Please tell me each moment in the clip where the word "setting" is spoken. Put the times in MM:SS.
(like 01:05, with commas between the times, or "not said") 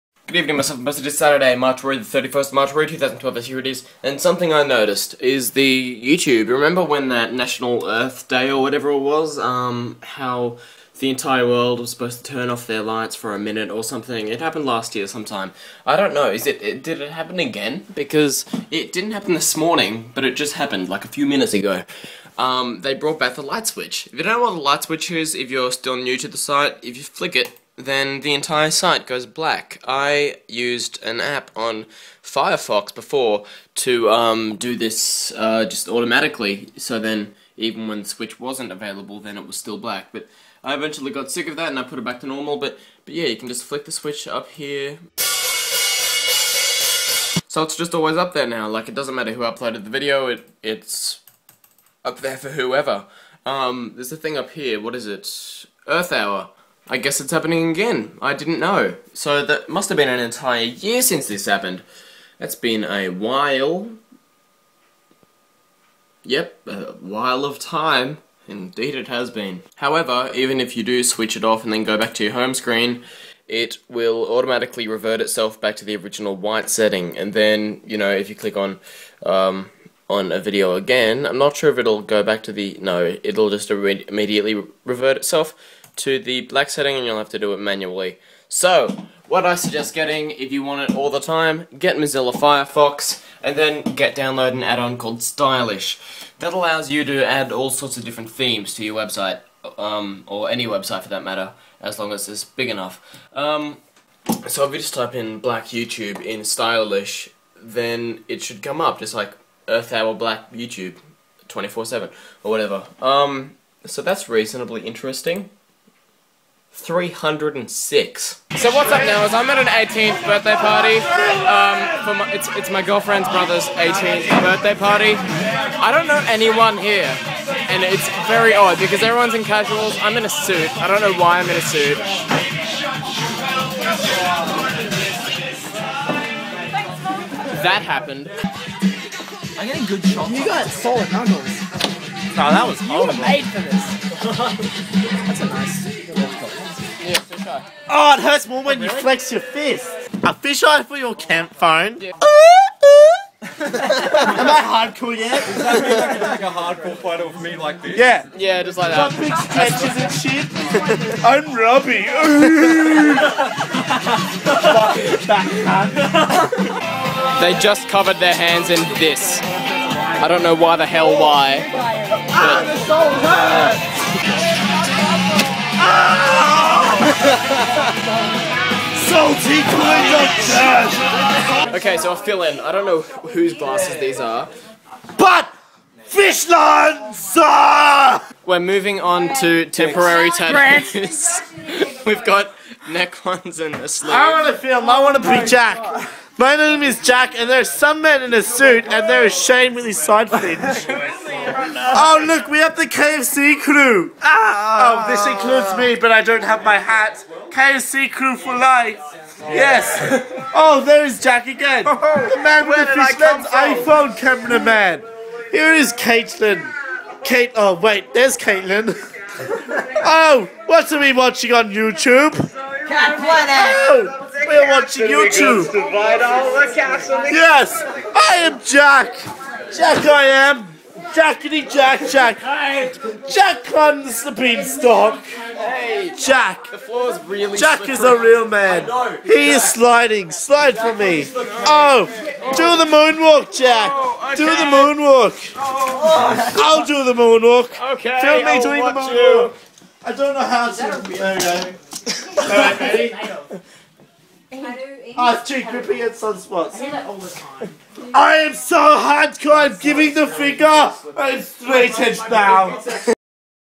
01:16, 01:26.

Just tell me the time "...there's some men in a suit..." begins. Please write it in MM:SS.
03:17.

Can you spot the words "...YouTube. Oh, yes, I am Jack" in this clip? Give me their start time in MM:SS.
03:45.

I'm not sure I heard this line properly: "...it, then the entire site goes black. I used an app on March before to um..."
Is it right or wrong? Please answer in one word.
wrong.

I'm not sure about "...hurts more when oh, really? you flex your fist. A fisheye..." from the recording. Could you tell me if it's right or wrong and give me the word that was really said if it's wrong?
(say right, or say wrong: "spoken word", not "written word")
right.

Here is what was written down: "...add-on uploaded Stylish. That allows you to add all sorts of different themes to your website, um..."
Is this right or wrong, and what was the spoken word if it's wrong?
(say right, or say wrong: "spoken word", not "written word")
wrong: "called", not "uploaded".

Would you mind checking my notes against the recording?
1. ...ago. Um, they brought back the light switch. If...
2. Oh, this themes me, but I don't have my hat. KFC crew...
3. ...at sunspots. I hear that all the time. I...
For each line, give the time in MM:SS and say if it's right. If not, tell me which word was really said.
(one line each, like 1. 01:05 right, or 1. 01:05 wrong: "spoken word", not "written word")
1. 00:21 right
2. 03:25 wrong: "includes", not "themes"
3. 04:16 right.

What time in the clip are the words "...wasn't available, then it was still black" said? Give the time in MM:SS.
00:38.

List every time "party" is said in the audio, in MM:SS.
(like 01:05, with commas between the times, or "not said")
02:00, 02:04.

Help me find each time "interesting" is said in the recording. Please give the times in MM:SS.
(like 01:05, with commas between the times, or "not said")
01:54.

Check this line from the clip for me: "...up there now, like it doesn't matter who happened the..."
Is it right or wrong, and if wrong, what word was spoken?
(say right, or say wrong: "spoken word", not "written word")
wrong: "uploaded", not "happened".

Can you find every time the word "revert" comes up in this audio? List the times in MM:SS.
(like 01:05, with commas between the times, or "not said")
01:14, 01:24.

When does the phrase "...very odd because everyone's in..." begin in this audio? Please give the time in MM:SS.
02:08.